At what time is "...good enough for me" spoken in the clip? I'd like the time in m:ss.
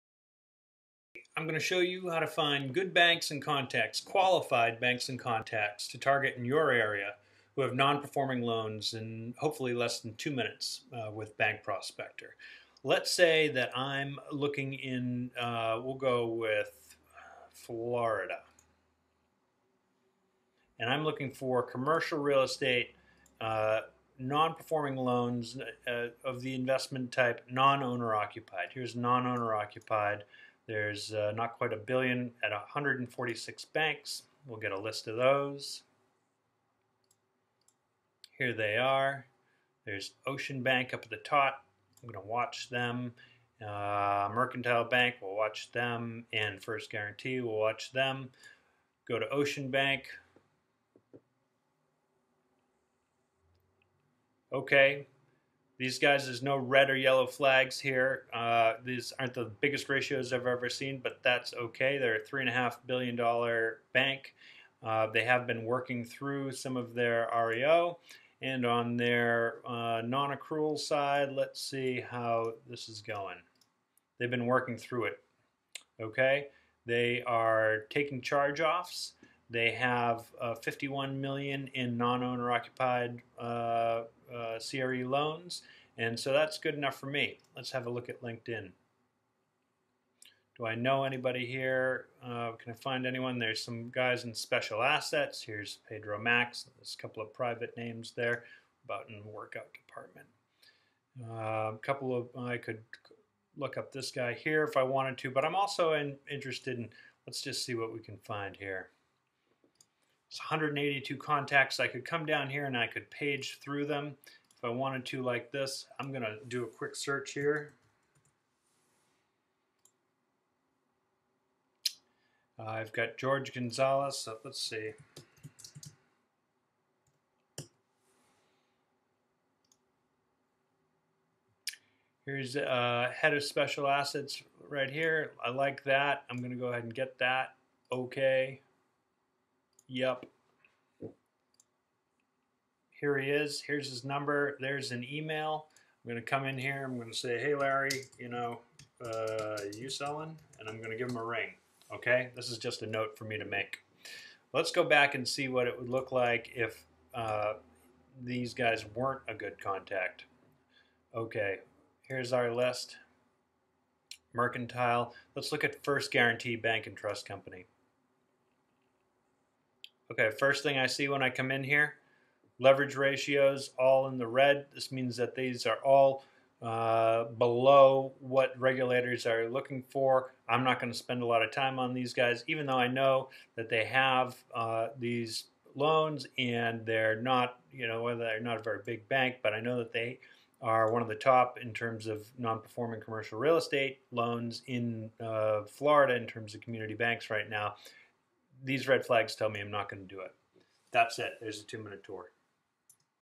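1:26.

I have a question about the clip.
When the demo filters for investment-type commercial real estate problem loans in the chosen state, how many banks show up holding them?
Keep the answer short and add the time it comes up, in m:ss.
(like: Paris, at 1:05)
146, at 0:32.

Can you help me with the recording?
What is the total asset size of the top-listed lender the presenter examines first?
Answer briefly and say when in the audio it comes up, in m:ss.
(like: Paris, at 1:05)
$3.5 billion, at 1:02.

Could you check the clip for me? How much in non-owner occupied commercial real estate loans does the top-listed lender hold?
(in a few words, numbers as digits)
51 million.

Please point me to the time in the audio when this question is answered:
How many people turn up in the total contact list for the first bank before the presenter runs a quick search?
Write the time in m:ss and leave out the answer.
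1:50.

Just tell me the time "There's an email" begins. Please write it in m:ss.
2:24.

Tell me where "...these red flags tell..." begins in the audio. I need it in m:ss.
3:18.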